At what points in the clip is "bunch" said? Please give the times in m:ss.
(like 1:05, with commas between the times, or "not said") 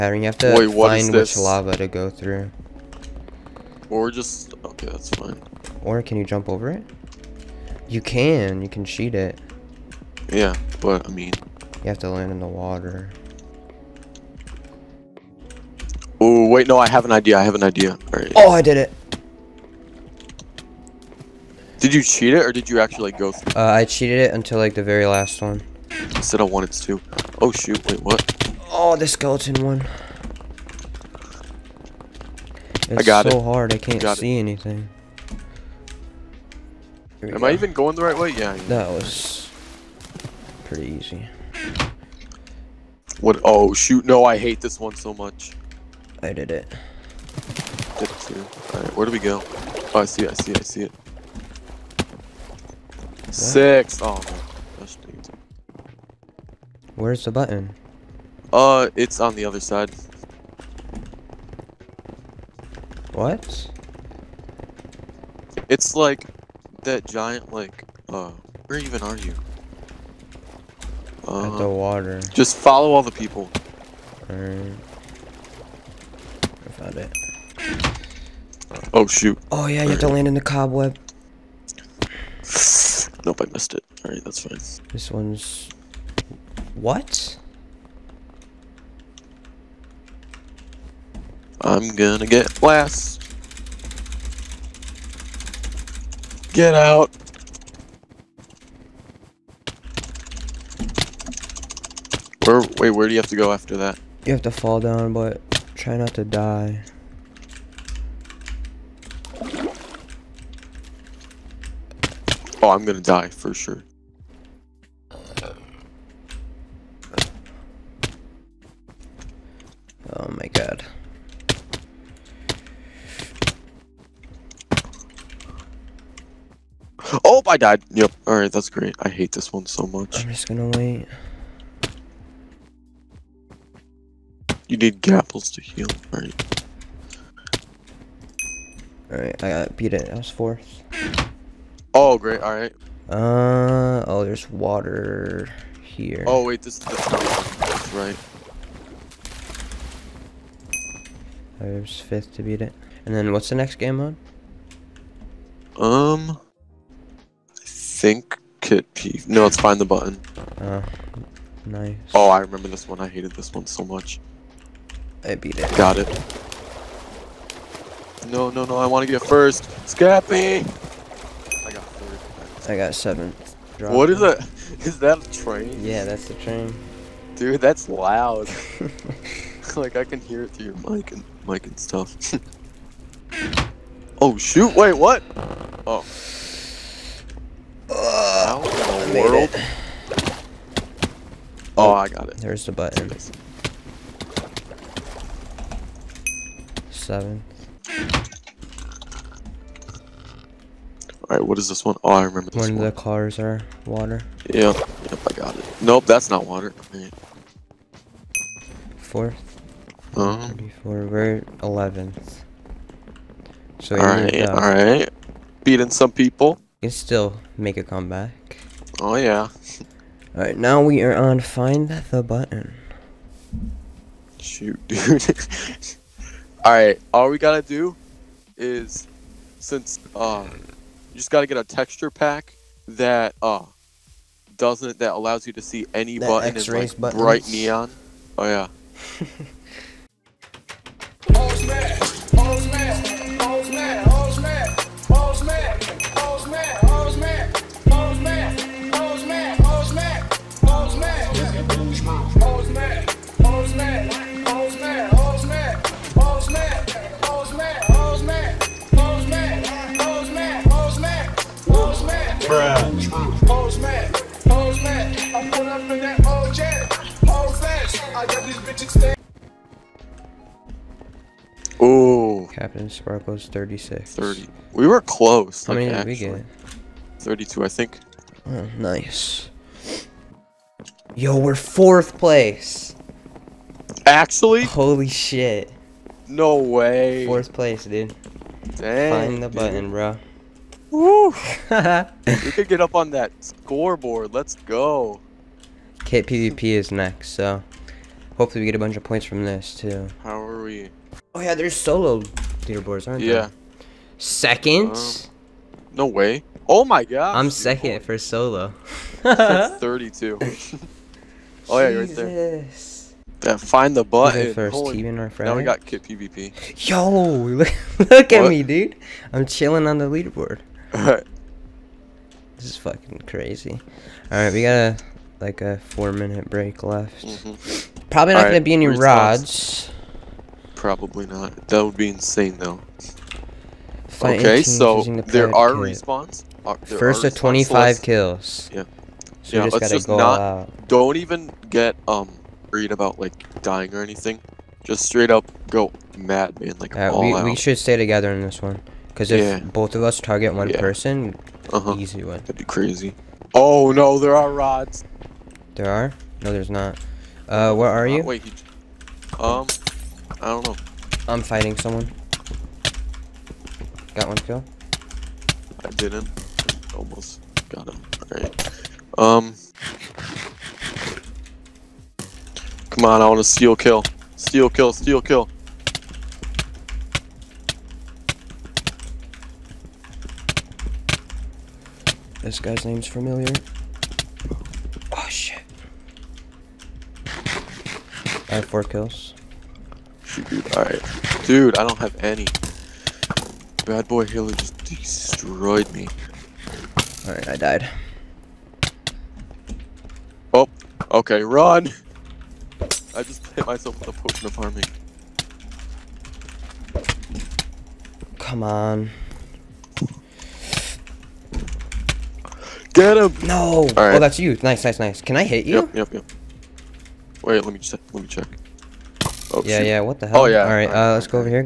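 4:58.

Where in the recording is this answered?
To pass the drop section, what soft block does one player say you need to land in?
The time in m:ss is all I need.
1:19.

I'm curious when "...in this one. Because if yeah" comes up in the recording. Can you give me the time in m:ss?
5:48.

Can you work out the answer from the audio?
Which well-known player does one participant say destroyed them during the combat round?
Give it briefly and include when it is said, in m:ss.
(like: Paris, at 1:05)
BadBoyHalo, at 6:33.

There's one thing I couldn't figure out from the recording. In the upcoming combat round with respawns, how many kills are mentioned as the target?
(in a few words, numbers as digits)
25.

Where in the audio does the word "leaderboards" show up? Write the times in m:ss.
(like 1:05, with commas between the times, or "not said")
5:02, 5:20.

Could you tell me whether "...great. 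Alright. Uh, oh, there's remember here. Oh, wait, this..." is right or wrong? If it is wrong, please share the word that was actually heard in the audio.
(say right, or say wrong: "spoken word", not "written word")
wrong: "water", not "remember".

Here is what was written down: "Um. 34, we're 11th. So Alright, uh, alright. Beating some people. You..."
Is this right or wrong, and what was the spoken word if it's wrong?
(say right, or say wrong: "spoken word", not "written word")
right.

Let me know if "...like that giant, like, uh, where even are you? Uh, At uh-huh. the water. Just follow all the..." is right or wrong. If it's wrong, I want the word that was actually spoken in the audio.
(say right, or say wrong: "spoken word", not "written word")
right.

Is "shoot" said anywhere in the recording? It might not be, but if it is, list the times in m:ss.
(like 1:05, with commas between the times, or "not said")
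0:27, 0:43, 1:19, 3:04, 3:44, 6:59.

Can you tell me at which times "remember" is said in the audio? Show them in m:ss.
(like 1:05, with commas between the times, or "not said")
2:42, 3:22.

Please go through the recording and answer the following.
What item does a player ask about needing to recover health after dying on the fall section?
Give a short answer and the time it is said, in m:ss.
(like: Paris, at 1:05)
gapples, at 2:14.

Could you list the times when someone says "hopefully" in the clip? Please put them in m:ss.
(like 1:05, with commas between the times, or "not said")
4:58.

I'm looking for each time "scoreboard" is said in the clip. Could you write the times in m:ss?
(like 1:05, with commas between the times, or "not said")
4:53.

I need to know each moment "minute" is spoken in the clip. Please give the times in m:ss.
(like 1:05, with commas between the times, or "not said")
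5:26.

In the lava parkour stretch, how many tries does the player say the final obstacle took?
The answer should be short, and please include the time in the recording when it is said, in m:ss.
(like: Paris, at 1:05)
2, at 0:26.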